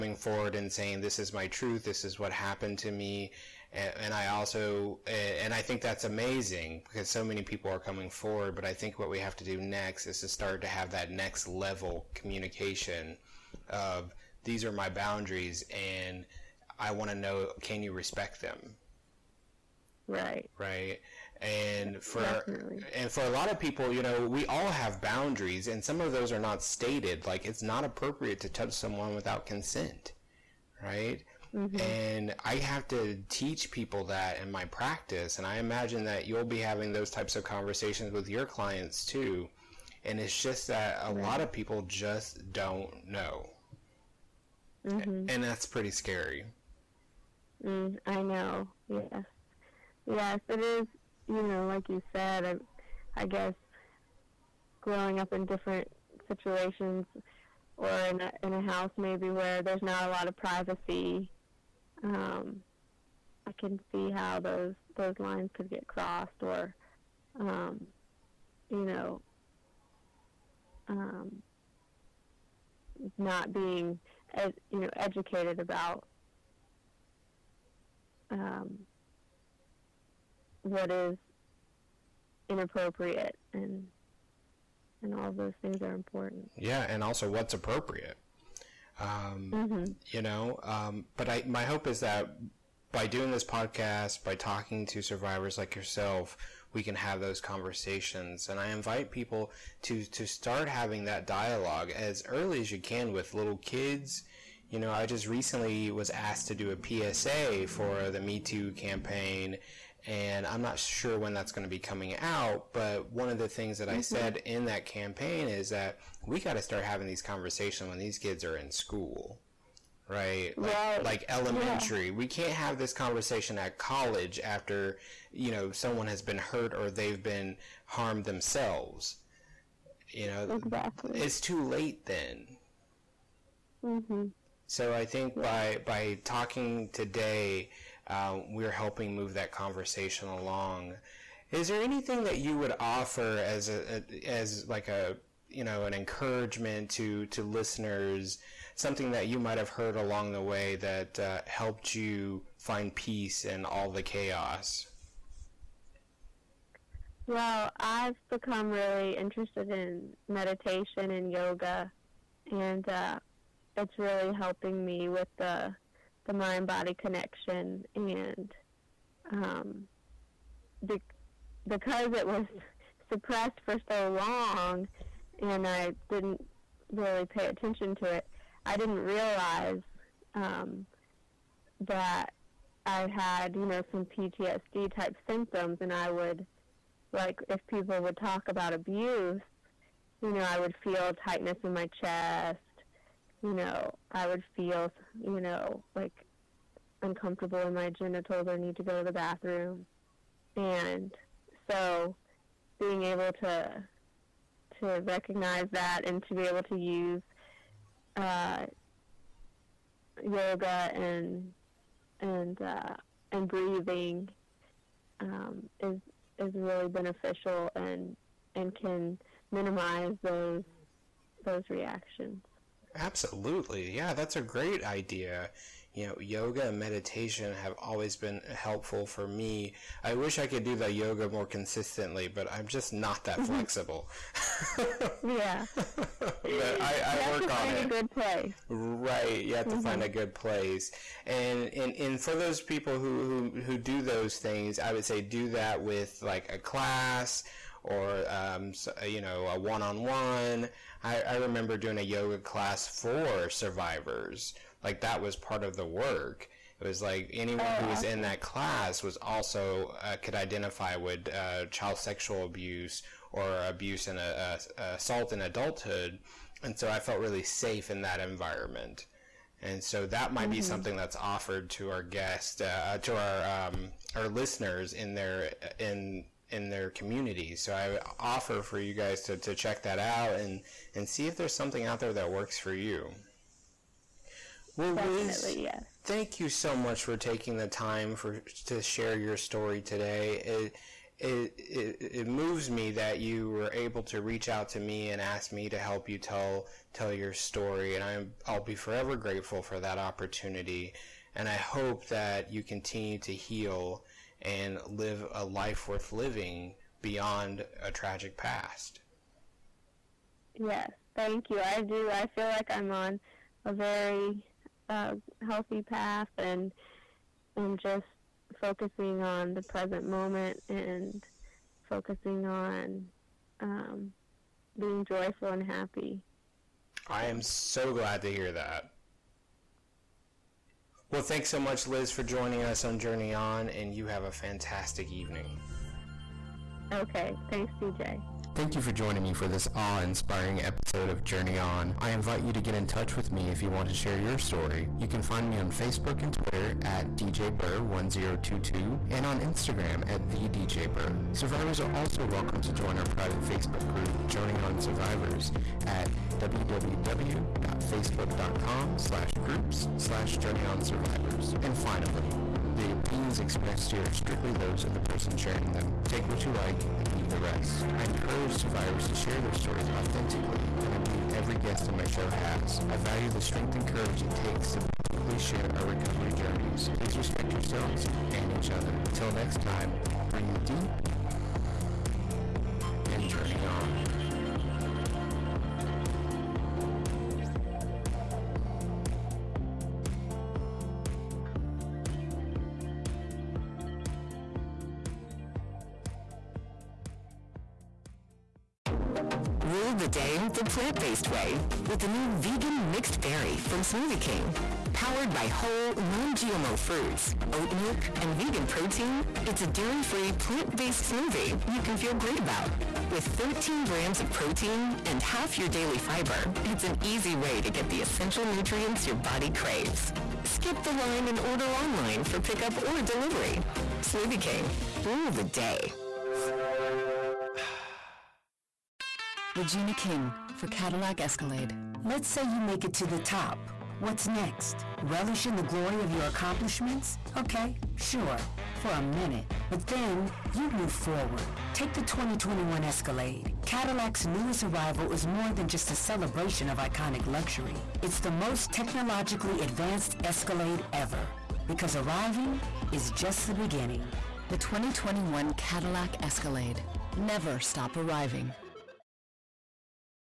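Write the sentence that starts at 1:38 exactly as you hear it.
And I invite people to to start having that dialogue as early as you can with little kids.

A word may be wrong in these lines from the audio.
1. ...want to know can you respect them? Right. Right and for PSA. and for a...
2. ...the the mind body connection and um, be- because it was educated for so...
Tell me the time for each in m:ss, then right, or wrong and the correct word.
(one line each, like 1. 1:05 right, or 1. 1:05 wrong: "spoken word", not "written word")
1. 0:16 wrong: "Definitely", not "PSA"
2. 2:45 wrong: "suppressed", not "educated".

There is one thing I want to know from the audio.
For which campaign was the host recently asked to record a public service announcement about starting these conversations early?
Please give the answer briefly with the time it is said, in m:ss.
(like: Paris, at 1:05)
Me Too, at 1:48.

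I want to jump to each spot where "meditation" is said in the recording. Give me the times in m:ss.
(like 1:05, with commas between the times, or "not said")
2:40, 3:46.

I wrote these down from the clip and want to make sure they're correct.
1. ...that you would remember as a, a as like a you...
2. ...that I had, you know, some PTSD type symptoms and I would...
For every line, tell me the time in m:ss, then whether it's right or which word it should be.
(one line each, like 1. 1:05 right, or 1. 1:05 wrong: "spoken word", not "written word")
1. 2:22 wrong: "offer", not "remember"
2. 3:01 right.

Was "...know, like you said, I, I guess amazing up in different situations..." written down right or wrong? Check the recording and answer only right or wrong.
wrong.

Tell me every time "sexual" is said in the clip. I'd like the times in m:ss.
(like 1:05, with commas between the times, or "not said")
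4:21.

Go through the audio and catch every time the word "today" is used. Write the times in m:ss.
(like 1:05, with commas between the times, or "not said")
2:16, 4:49.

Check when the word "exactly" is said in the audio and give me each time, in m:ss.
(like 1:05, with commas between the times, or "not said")
2:10.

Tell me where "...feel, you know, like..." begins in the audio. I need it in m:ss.
3:14.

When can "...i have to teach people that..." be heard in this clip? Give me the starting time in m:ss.
0:32.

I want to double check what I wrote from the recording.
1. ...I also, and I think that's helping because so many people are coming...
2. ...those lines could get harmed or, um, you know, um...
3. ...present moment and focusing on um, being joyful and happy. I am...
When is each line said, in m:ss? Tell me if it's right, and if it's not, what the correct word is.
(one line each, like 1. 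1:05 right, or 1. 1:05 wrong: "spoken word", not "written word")
1. 0:04 wrong: "amazing", not "helping"
2. 1:04 wrong: "crossed", not "harmed"
3. 5:19 right.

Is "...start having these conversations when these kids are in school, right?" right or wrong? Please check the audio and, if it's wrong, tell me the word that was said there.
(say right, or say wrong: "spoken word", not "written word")
right.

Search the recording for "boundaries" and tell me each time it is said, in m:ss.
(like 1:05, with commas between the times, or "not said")
0:14, 0:24.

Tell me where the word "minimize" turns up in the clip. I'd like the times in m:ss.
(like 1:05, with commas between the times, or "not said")
3:39.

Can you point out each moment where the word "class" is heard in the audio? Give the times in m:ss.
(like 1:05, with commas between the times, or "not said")
4:06, 4:12, 4:18.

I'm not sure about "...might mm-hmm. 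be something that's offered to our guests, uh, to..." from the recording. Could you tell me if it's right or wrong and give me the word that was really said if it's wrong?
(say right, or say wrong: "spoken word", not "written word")
right.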